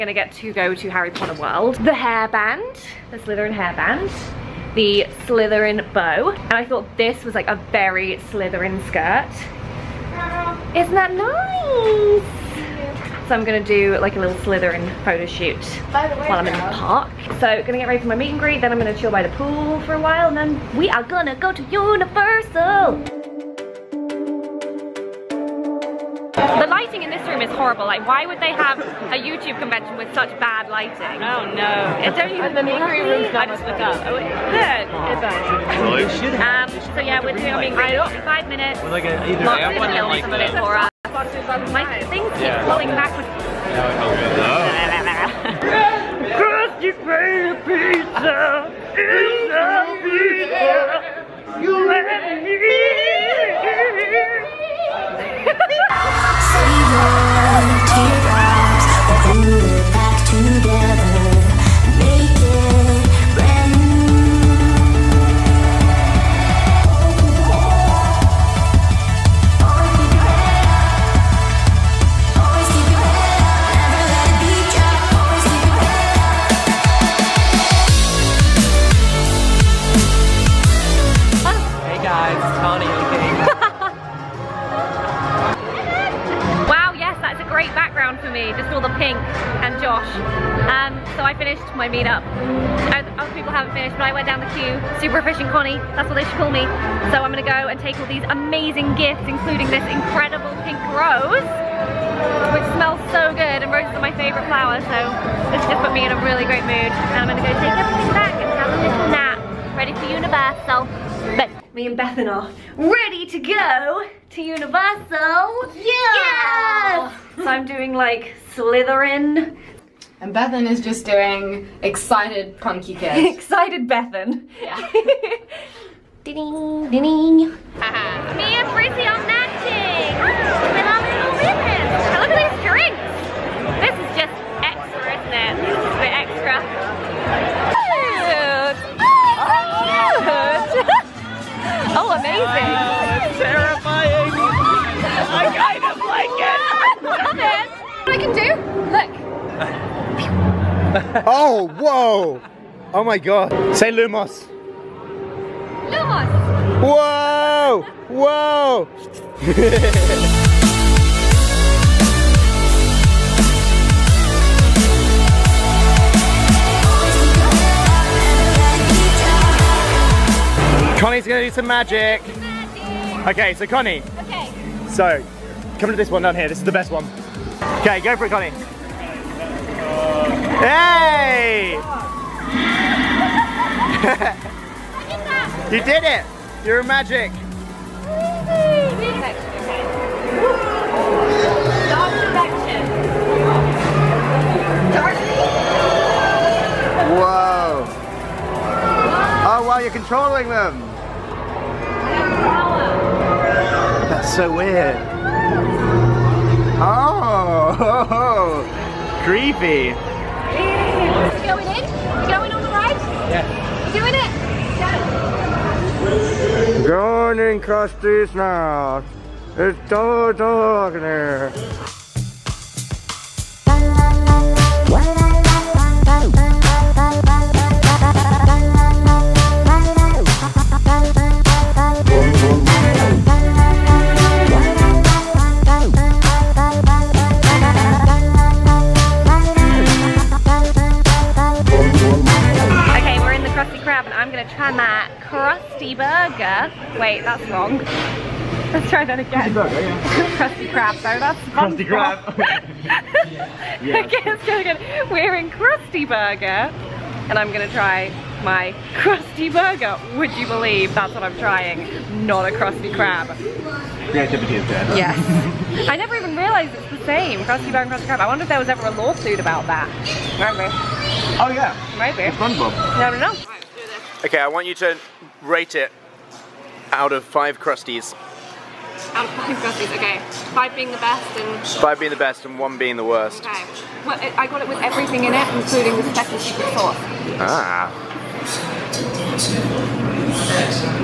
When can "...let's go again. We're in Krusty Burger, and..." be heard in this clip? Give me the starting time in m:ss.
4:14.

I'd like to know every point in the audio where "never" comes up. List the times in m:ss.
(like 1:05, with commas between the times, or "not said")
4:25.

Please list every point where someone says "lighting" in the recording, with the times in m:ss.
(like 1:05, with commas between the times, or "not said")
0:26, 0:30.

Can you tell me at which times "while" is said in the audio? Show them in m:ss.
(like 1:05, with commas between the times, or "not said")
0:15, 0:20.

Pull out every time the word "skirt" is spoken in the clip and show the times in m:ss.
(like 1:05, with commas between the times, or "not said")
0:08.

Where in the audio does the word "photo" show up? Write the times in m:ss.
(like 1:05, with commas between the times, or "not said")
0:15.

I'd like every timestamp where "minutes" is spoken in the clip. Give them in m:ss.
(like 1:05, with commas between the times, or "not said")
0:38.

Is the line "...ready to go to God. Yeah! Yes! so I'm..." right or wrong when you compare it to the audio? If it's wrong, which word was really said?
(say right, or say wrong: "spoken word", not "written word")
wrong: "Universal", not "God".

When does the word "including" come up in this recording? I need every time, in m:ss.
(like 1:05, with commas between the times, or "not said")
1:39, 4:45.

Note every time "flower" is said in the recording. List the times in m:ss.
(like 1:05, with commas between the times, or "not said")
1:44.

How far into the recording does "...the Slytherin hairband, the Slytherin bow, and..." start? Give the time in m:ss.
0:03.